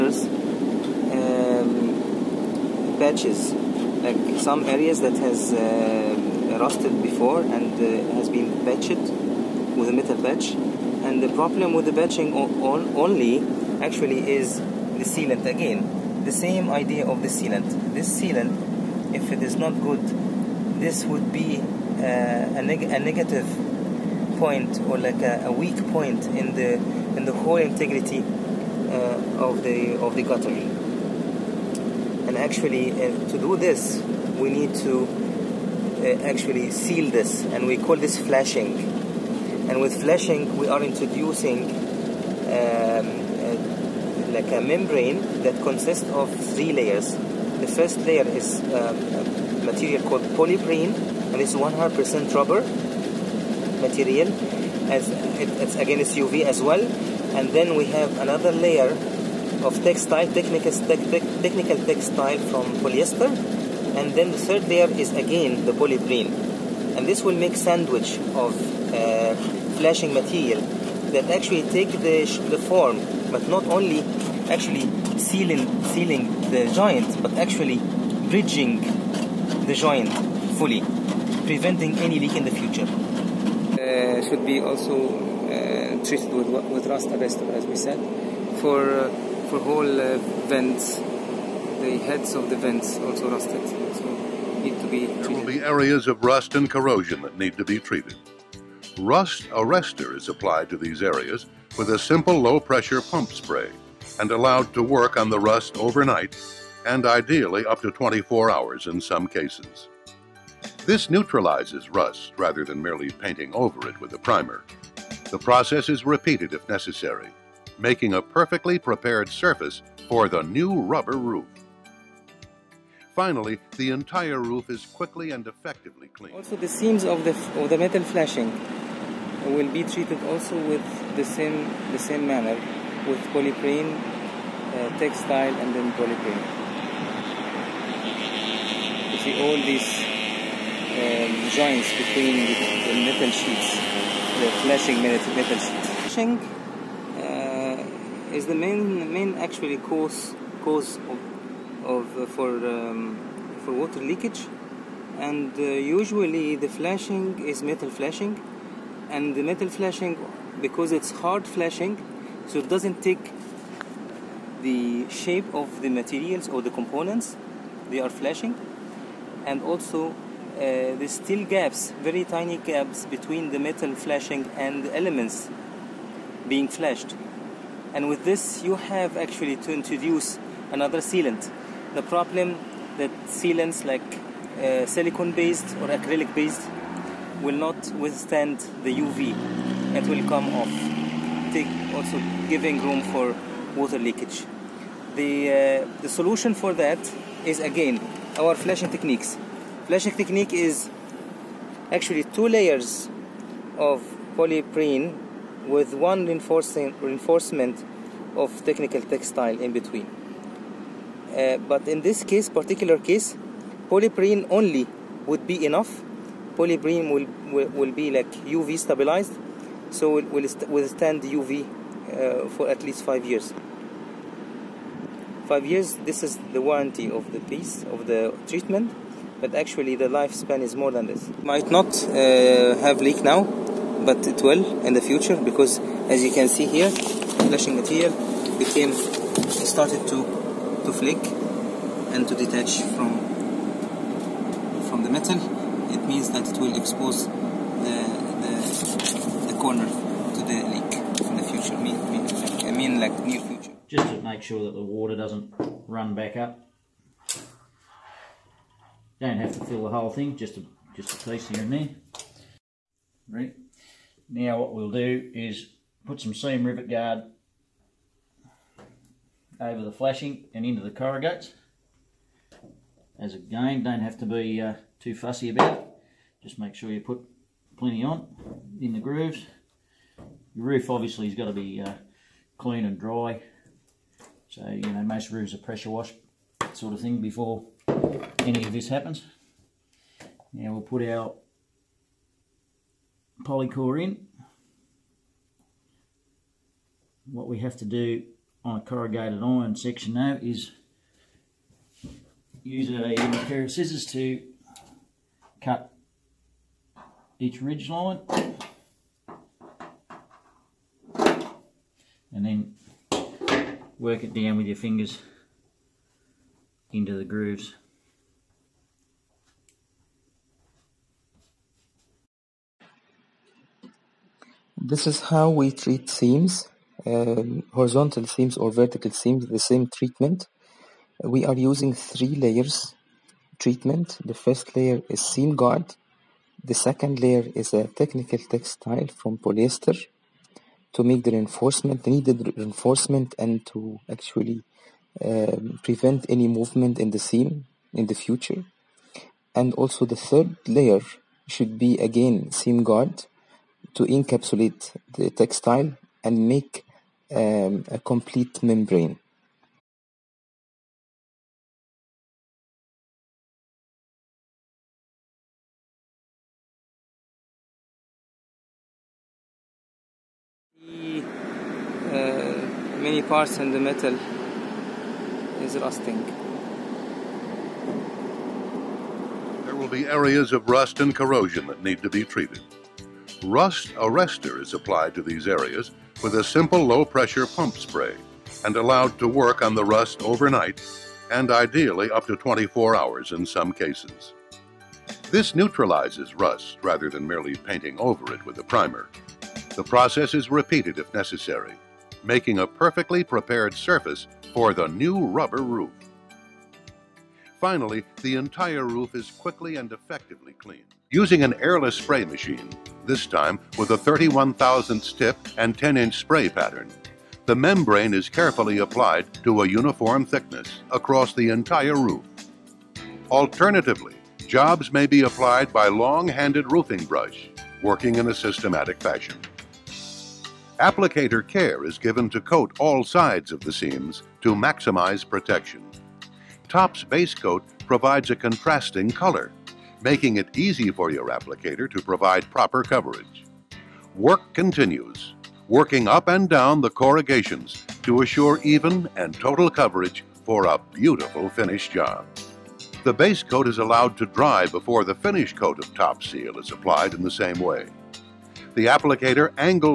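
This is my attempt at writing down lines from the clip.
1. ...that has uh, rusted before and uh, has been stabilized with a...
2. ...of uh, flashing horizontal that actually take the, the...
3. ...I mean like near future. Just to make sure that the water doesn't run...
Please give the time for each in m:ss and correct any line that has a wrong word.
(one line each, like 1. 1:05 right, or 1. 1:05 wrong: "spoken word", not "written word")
1. 0:05 wrong: "patched", not "stabilized"
2. 1:08 wrong: "material", not "horizontal"
3. 4:12 right.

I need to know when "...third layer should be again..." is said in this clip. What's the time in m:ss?
5:50.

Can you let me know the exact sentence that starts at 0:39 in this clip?
And with flashing, we are introducing um, uh, like a membrane that consists of three layers.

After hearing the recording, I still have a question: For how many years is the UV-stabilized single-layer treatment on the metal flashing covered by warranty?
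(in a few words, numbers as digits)
5 years.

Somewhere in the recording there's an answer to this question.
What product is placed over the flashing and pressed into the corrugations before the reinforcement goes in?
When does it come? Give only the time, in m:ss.
4:26.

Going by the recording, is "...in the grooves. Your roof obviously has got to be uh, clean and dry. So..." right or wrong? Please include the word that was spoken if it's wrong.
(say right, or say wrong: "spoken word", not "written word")
right.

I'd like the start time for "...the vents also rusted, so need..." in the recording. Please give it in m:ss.
1:32.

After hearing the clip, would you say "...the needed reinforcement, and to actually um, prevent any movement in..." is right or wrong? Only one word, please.
right.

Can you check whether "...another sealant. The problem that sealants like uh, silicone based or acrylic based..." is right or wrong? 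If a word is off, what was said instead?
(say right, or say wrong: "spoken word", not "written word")
right.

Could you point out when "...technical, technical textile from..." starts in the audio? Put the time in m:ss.
1:00.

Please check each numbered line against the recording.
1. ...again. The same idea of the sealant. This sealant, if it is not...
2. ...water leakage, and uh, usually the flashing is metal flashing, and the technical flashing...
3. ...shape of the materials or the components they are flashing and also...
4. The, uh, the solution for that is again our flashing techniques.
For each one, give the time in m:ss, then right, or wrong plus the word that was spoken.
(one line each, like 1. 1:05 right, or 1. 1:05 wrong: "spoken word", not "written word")
1. 0:15 right
2. 2:33 wrong: "metal", not "technical"
3. 2:45 right
4. 3:15 right.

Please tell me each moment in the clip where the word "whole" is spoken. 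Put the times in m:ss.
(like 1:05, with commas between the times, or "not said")
0:27, 1:29, 4:19.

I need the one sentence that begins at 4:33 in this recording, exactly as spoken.
As again, don't have to be uh, too fussy about it.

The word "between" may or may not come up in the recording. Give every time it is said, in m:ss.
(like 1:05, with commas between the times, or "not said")
2:21, 2:53, 3:29.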